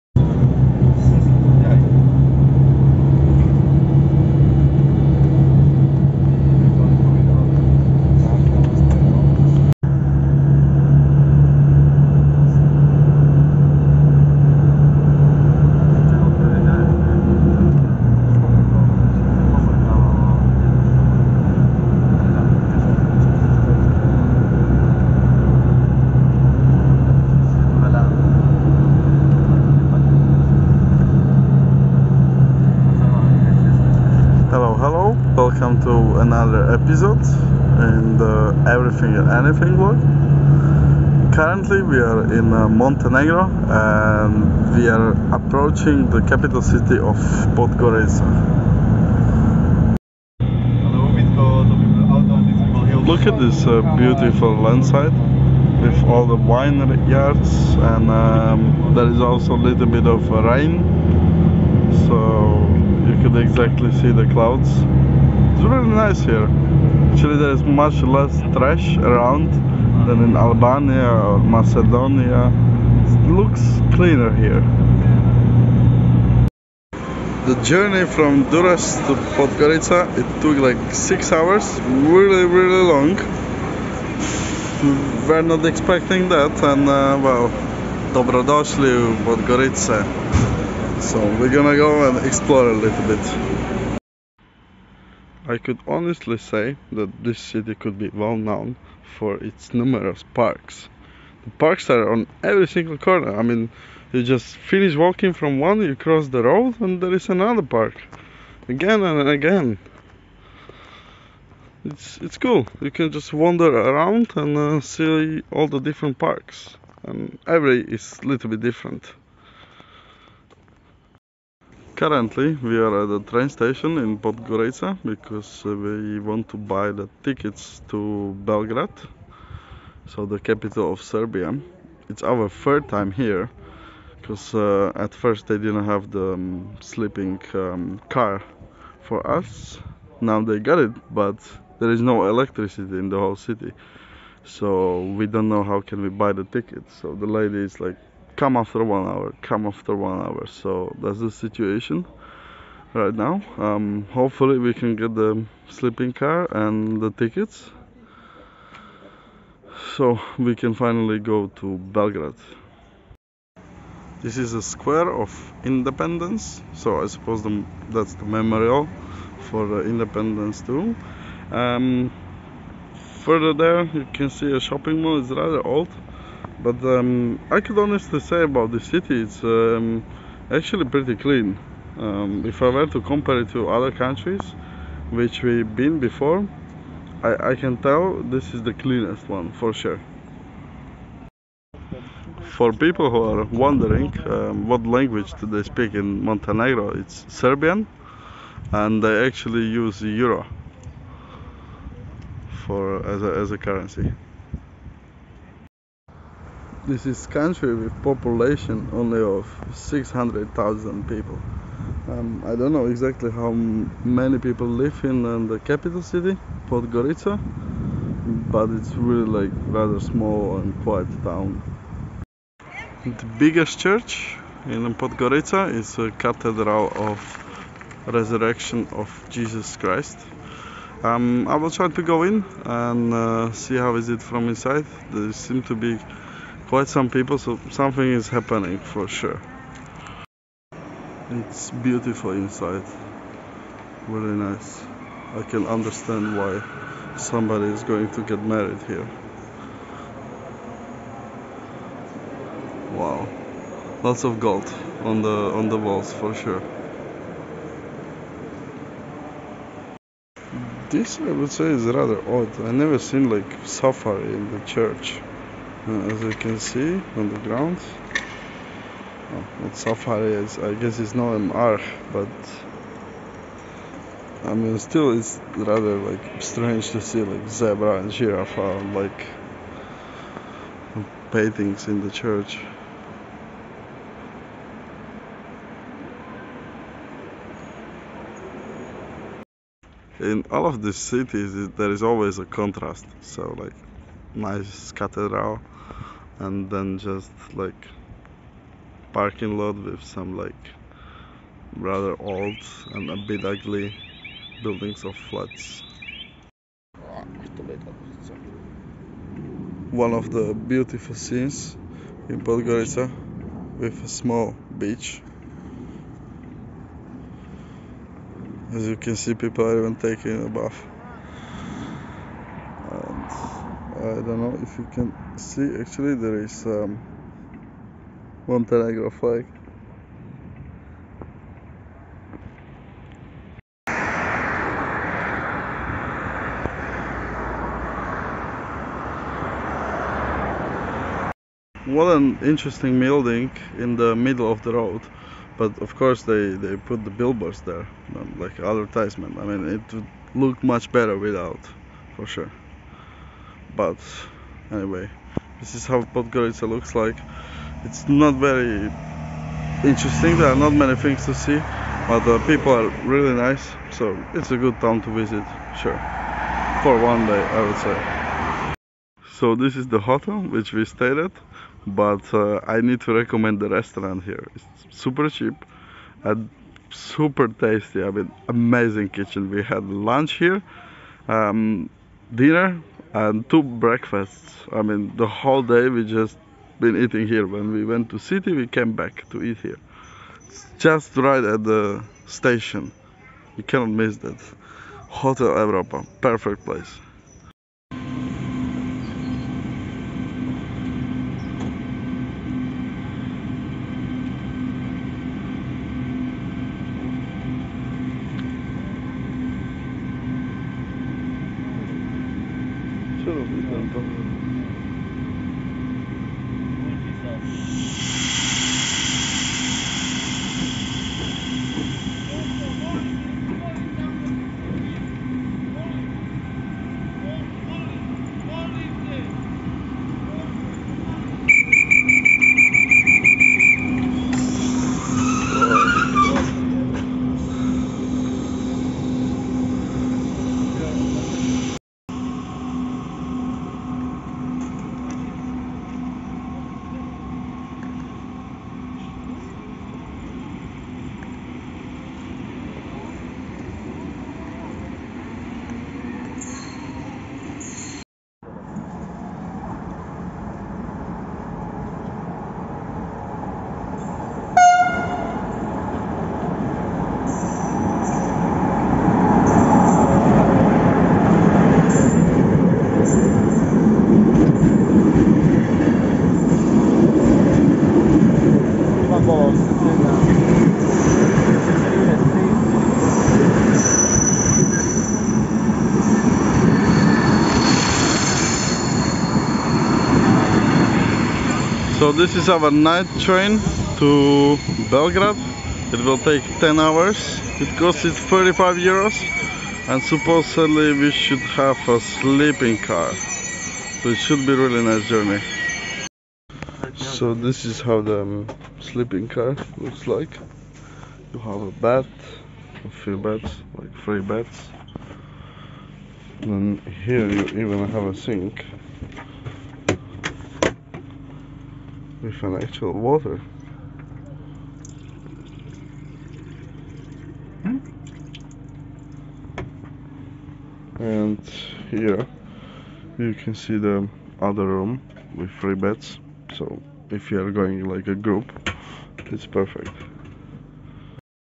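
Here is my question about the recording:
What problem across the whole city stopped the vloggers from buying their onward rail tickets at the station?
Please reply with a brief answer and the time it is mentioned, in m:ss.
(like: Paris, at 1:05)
No electricity, at 2:22.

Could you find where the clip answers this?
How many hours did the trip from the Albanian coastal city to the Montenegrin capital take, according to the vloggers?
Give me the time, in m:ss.
1:20.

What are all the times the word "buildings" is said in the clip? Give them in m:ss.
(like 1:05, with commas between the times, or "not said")
5:04, 5:42.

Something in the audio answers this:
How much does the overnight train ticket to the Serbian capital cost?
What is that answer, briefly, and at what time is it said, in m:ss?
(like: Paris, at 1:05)
35 euros, at 8:18.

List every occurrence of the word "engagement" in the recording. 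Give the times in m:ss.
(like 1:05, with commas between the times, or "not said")
not said.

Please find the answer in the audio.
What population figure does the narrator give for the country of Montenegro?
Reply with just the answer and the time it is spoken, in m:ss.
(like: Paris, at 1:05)
600,000, at 3:29.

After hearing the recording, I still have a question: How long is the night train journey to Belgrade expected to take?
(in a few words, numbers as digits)
10 hours.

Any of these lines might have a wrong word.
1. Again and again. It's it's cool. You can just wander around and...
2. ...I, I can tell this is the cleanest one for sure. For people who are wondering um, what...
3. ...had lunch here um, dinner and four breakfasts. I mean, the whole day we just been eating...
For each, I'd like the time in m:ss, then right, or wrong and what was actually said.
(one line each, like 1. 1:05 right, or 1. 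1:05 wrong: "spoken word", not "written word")
1. 1:48 right
2. 3:07 right
3. 6:19 wrong: "two", not "four".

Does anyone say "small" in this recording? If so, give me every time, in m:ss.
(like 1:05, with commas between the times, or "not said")
3:39, 5:14.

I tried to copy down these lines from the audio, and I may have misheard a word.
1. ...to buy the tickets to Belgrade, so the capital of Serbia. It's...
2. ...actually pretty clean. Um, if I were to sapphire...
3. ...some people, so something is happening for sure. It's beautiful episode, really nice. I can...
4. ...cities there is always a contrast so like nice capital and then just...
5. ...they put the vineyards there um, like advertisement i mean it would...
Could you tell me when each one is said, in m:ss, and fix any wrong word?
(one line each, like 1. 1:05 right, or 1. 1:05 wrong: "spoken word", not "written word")
1. 2:06 right
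2. 3:00 wrong: "compare", not "sapphire"
3. 3:56 wrong: "inside", not "episode"
4. 4:50 wrong: "cathedral", not "capital"
5. 5:46 wrong: "billboards", not "vineyards".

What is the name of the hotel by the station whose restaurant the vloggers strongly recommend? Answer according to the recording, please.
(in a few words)
Hotel Europa.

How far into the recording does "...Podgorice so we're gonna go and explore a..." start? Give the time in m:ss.
1:29.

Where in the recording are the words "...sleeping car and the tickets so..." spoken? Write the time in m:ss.
2:35.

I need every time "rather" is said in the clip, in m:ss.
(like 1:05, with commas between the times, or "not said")
2:55, 3:39, 4:21, 4:35, 5:01.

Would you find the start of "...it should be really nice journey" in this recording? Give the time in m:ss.
8:24.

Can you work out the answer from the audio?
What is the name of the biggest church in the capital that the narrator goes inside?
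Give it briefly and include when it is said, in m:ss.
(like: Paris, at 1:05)
Cathedral of Resurrection, at 3:46.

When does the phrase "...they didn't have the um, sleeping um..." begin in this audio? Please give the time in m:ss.
2:15.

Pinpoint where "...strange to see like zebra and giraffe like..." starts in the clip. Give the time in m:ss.
4:36.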